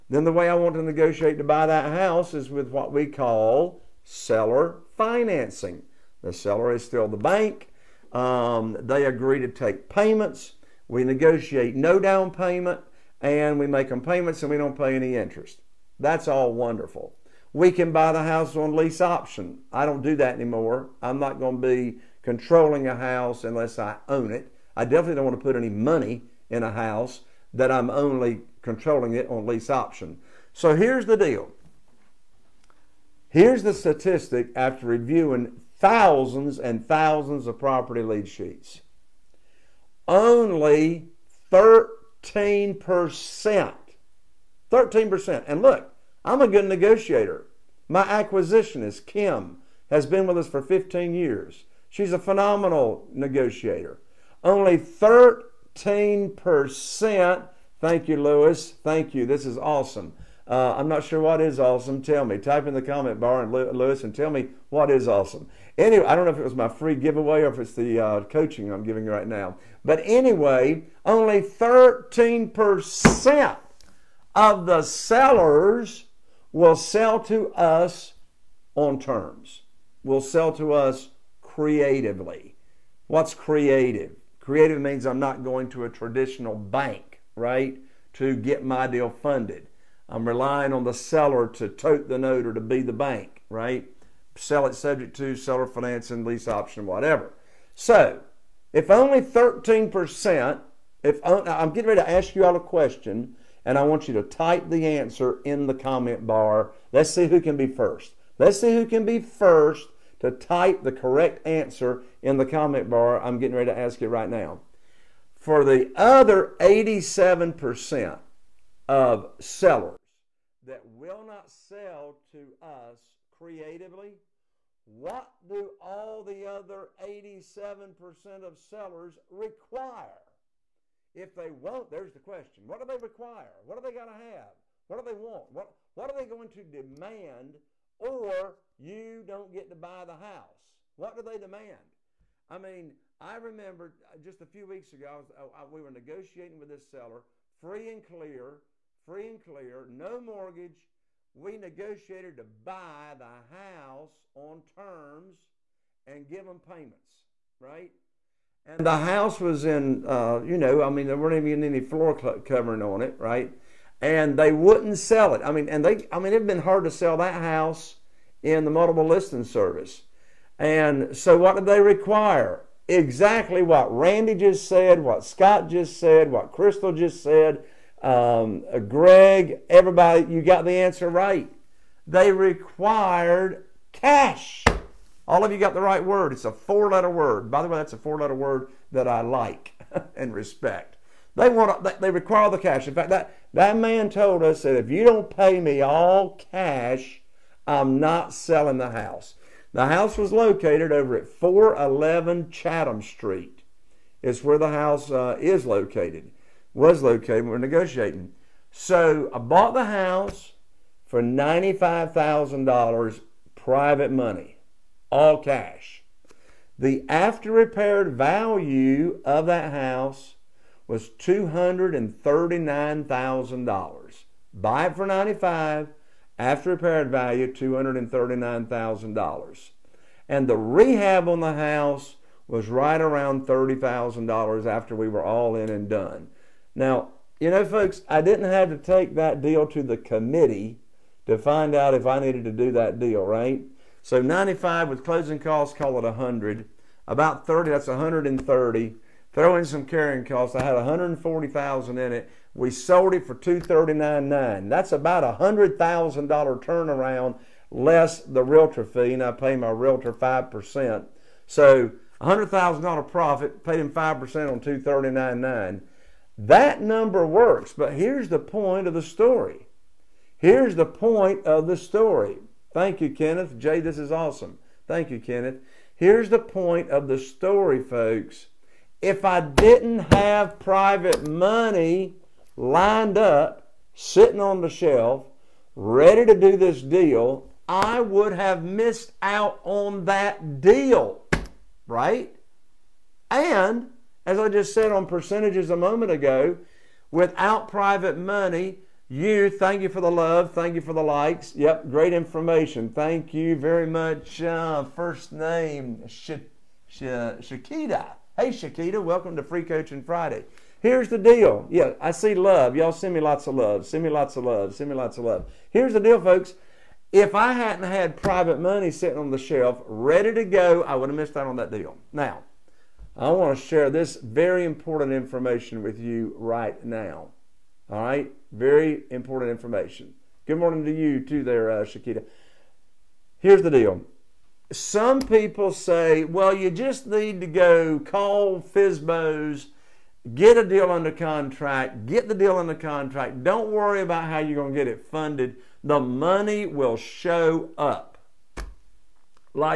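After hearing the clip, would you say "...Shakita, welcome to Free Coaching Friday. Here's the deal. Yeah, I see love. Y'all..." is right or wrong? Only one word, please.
right.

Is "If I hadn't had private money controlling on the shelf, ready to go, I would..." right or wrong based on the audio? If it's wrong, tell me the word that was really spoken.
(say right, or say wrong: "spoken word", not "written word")
wrong: "sitting", not "controlling".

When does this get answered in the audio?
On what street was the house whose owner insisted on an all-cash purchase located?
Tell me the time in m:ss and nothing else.
3:22.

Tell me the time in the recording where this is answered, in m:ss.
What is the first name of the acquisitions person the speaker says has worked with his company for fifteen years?
0:49.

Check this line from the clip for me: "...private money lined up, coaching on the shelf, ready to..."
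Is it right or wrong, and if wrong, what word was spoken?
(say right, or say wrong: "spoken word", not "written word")
wrong: "sitting", not "coaching".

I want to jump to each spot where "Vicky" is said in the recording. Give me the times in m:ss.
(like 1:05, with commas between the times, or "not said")
not said.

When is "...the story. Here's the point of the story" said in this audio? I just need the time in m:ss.
4:28.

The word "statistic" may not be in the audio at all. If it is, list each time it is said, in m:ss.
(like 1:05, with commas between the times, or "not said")
0:33.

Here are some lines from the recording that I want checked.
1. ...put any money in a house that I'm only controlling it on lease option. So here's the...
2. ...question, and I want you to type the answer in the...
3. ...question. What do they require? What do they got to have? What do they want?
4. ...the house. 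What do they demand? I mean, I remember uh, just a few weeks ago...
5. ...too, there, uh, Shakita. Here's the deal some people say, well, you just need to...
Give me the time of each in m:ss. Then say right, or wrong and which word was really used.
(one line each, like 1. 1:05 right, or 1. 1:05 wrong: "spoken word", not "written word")
1. 0:25 right
2. 1:42 right
3. 2:12 right
4. 2:20 right
5. 5:31 right.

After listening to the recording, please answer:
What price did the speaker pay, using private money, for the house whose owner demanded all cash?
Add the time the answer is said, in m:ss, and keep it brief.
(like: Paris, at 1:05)
$95,000, at 3:31.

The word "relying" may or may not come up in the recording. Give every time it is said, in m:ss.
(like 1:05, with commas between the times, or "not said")
1:30.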